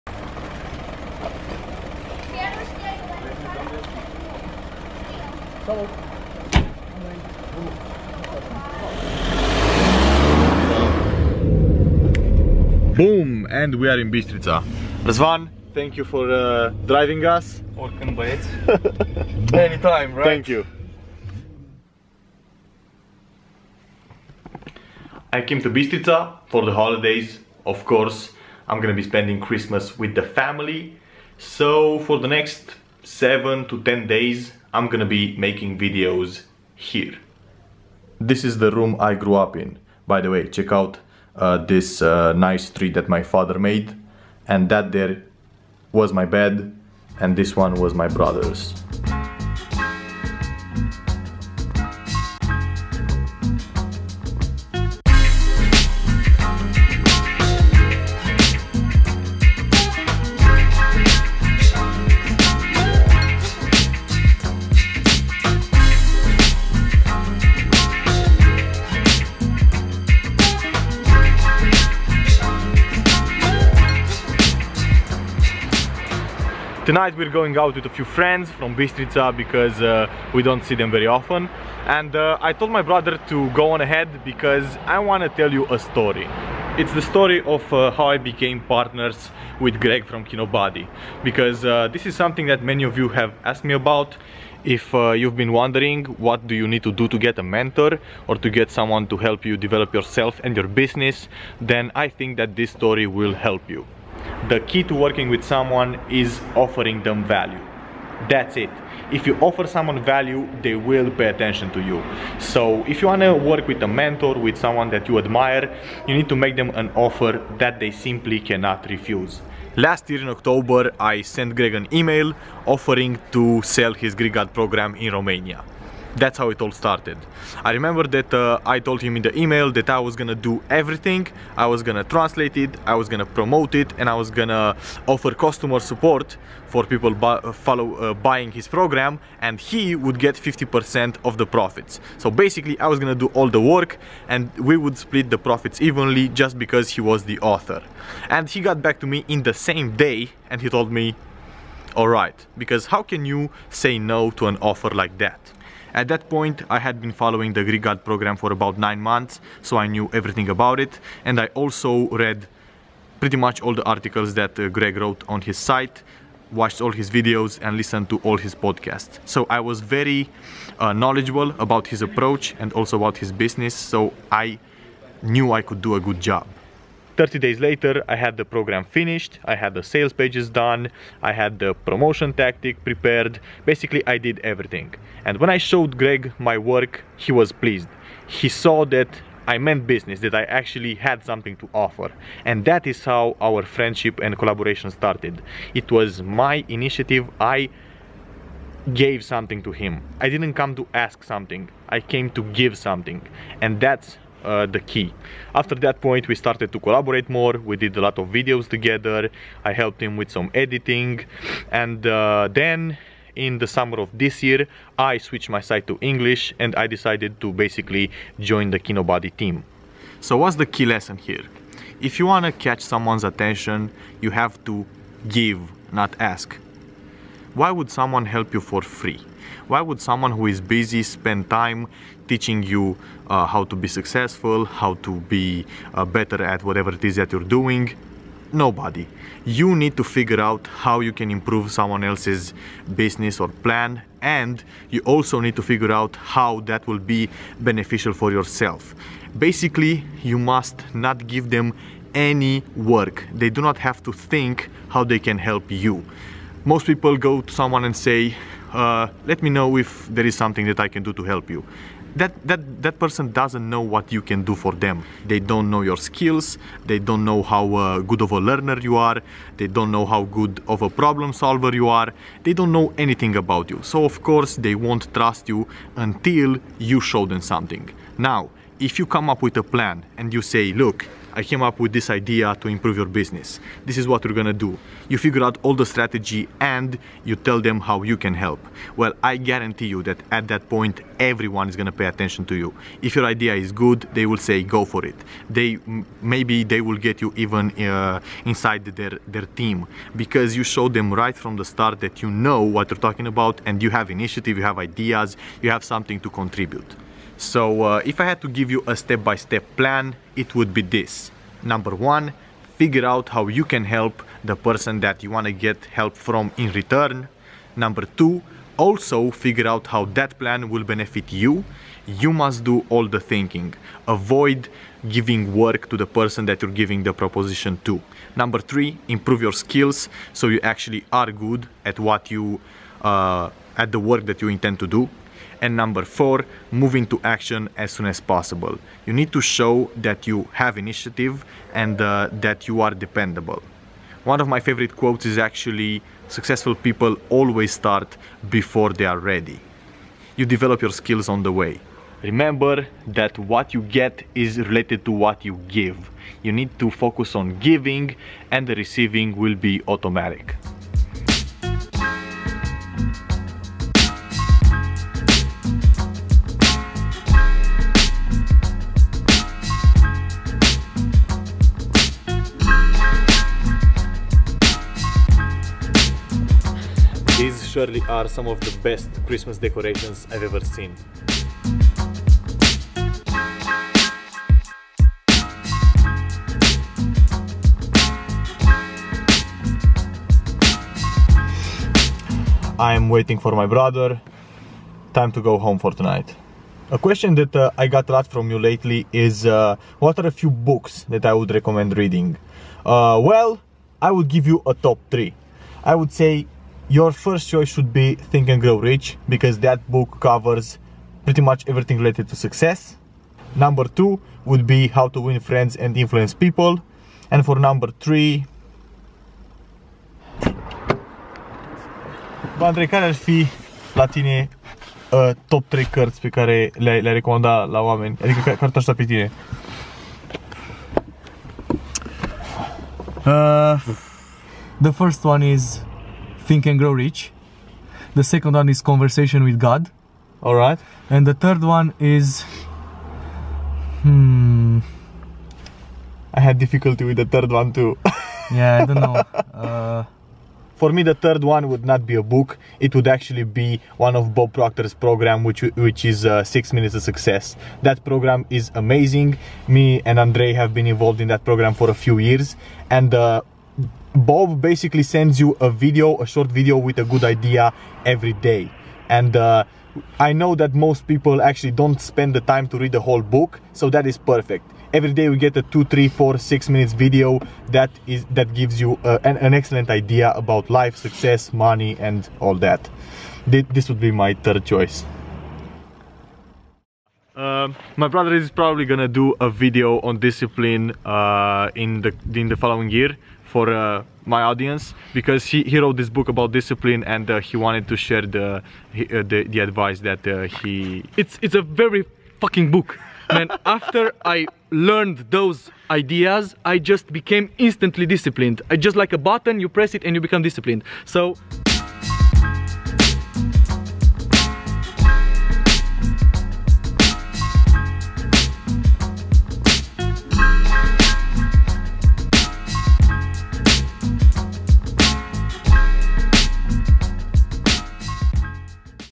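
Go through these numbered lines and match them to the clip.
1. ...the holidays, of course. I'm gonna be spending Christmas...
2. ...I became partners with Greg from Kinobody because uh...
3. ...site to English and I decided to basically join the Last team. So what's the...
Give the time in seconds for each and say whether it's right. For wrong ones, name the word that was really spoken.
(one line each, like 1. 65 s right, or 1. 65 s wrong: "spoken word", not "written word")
1. 26 s right
2. 88 s right
3. 215 s wrong: "Kinobody", not "Last".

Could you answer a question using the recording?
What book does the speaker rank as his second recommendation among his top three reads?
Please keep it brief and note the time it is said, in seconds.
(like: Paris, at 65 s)
How to Win Friends and Influence People, at 414 s.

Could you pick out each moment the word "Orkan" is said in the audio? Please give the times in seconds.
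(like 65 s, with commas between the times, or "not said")
17 s.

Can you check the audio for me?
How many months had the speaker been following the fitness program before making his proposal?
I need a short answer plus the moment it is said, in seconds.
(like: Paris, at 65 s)
nine, at 158 s.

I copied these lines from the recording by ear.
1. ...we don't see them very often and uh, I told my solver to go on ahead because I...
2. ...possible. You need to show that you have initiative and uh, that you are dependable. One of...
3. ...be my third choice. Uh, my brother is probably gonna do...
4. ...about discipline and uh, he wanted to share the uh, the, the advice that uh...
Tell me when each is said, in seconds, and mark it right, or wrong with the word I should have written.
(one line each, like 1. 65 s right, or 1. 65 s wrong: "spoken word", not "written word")
1. 80 s wrong: "brother", not "solver"
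2. 338 s right
3. 484 s right
4. 496 s right.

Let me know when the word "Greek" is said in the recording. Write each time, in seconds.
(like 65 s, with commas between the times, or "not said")
124 s, 157 s.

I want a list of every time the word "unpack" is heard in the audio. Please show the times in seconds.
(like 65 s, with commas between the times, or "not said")
not said.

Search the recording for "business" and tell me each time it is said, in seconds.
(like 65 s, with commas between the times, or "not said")
100 s, 173 s, 189 s, 242 s, 283 s.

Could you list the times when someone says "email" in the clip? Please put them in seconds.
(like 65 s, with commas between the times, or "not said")
121 s, 129 s.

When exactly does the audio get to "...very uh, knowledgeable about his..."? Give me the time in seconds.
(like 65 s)
169 s.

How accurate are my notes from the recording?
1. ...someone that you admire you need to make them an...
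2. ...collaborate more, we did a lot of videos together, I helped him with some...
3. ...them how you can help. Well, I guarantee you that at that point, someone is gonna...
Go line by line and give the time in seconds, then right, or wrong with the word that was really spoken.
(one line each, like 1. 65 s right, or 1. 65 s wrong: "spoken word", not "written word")
1. 114 s right
2. 206 s right
3. 287 s wrong: "everyone", not "someone".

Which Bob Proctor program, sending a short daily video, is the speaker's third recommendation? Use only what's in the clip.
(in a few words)
Six Minutes of Success.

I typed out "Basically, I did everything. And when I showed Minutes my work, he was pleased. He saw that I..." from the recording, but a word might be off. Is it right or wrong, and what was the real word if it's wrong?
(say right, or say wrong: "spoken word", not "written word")
wrong: "Greg", not "Minutes".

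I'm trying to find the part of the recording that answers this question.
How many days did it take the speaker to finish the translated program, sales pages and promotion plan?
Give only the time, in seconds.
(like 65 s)
177 s.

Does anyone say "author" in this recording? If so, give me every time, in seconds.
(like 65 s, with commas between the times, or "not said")
147 s.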